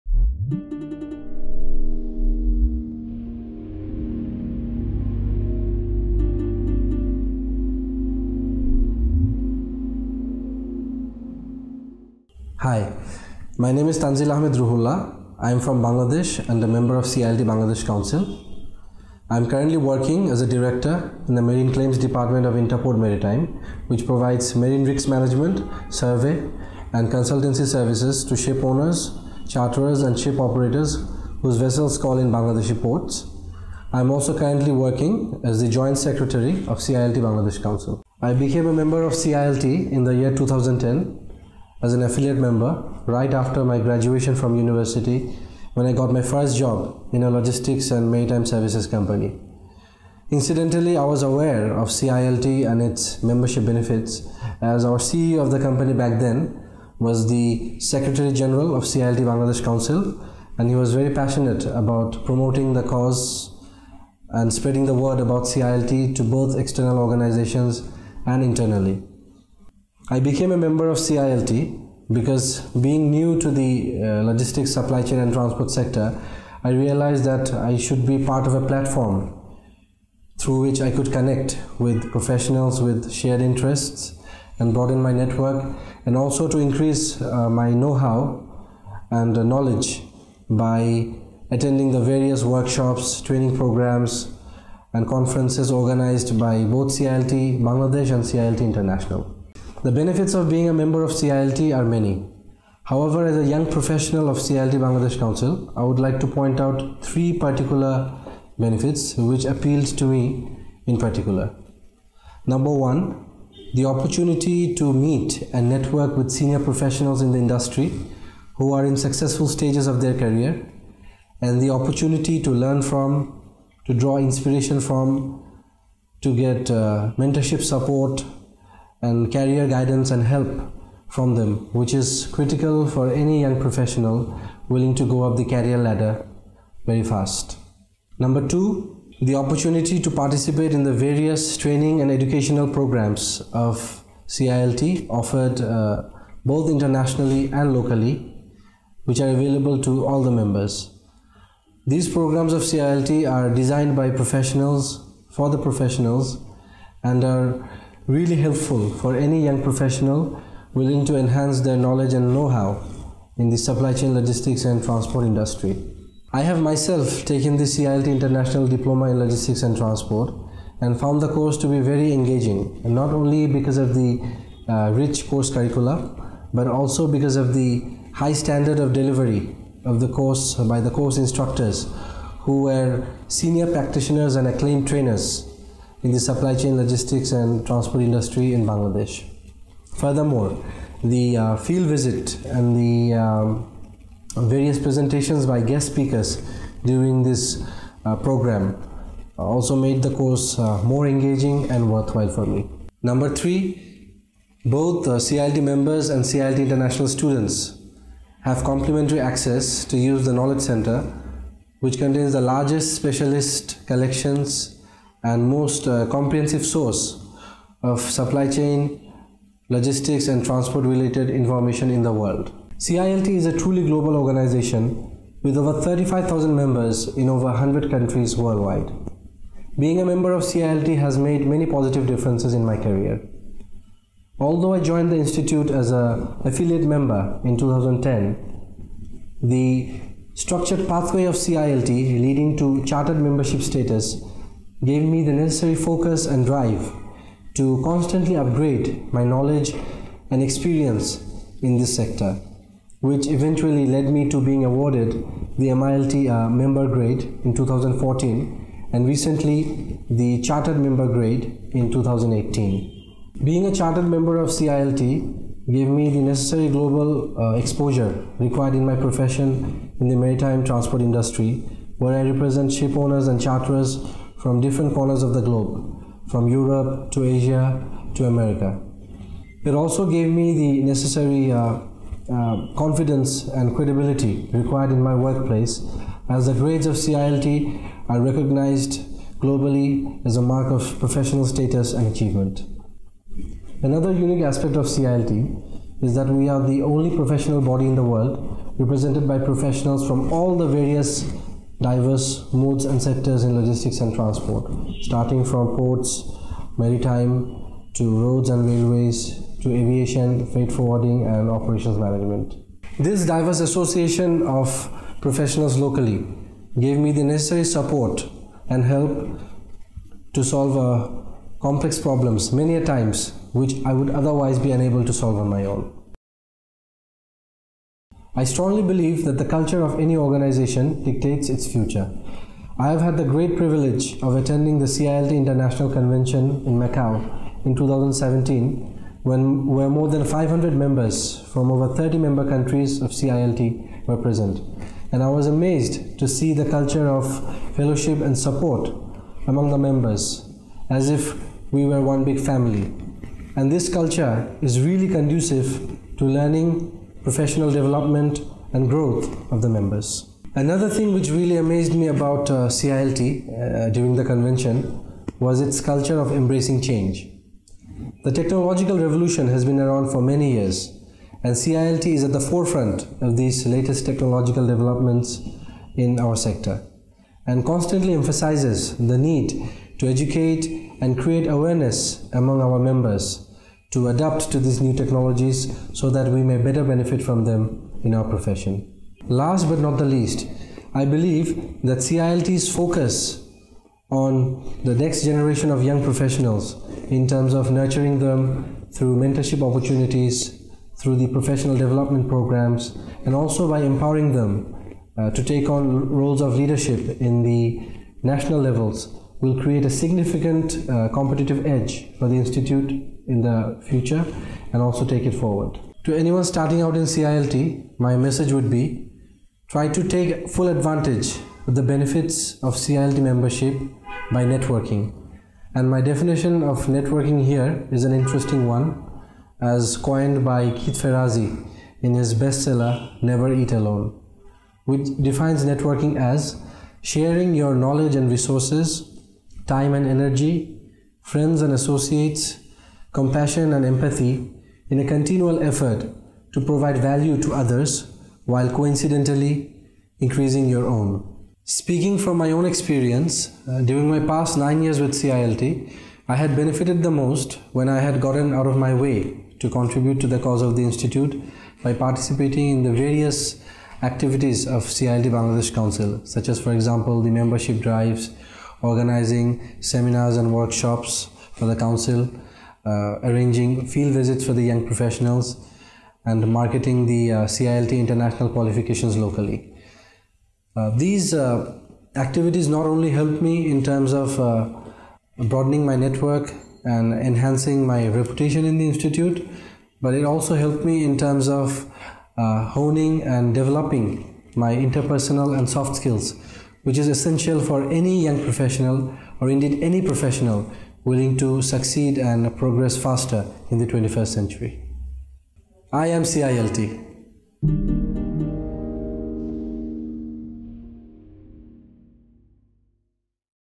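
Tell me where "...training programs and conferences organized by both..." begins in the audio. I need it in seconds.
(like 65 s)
93 s.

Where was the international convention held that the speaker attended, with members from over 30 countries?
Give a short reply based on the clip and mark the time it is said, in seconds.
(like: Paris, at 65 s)
Macau, at 336 s.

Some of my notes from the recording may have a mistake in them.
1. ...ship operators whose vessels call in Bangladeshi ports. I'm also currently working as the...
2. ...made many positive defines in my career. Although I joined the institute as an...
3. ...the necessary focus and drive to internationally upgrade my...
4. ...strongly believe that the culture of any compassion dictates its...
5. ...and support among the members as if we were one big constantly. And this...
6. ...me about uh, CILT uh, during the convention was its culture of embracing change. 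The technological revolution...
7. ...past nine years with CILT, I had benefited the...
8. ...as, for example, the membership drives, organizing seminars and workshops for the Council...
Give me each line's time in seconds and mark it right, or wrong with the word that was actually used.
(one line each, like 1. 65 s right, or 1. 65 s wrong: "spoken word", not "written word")
1. 30 s right
2. 231 s wrong: "differences", not "defines"
3. 245 s wrong: "constantly", not "internationally"
4. 328 s wrong: "organization", not "compassion"
5. 348 s wrong: "family", not "constantly"
6. 361 s right
7. 454 s right
8. 466 s right.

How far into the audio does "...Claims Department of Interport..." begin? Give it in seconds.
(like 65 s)
21 s.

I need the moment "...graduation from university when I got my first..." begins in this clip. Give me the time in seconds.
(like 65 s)
43 s.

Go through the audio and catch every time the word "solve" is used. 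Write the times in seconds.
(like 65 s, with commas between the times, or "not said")
320 s, 325 s.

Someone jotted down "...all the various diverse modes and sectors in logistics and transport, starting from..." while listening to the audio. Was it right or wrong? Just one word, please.
right.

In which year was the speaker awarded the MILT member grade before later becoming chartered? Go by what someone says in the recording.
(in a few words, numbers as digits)
2014.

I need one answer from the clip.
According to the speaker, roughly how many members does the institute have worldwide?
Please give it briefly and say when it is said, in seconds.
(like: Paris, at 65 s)
over 35,000, at 225 s.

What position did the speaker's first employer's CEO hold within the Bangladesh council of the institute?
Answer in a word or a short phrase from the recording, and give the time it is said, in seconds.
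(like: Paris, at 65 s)
Secretary General, at 57 s.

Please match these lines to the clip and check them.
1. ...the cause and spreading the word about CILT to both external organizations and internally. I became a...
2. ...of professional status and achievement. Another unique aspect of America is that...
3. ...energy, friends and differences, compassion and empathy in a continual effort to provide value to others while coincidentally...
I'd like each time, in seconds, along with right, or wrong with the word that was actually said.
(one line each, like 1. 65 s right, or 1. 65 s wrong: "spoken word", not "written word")
1. 62 s right
2. 290 s wrong: "CILT", not "America"
3. 440 s wrong: "associates", not "differences".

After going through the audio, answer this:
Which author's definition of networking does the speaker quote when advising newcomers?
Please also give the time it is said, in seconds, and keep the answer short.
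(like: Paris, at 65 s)
Keith Ferrazzi, at 430 s.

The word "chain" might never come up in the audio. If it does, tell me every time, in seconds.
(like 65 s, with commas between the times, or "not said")
75 s, 163 s, 186 s, 218 s.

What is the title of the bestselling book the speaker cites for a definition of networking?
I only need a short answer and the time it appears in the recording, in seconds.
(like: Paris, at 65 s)
Never Eat Alone, at 433 s.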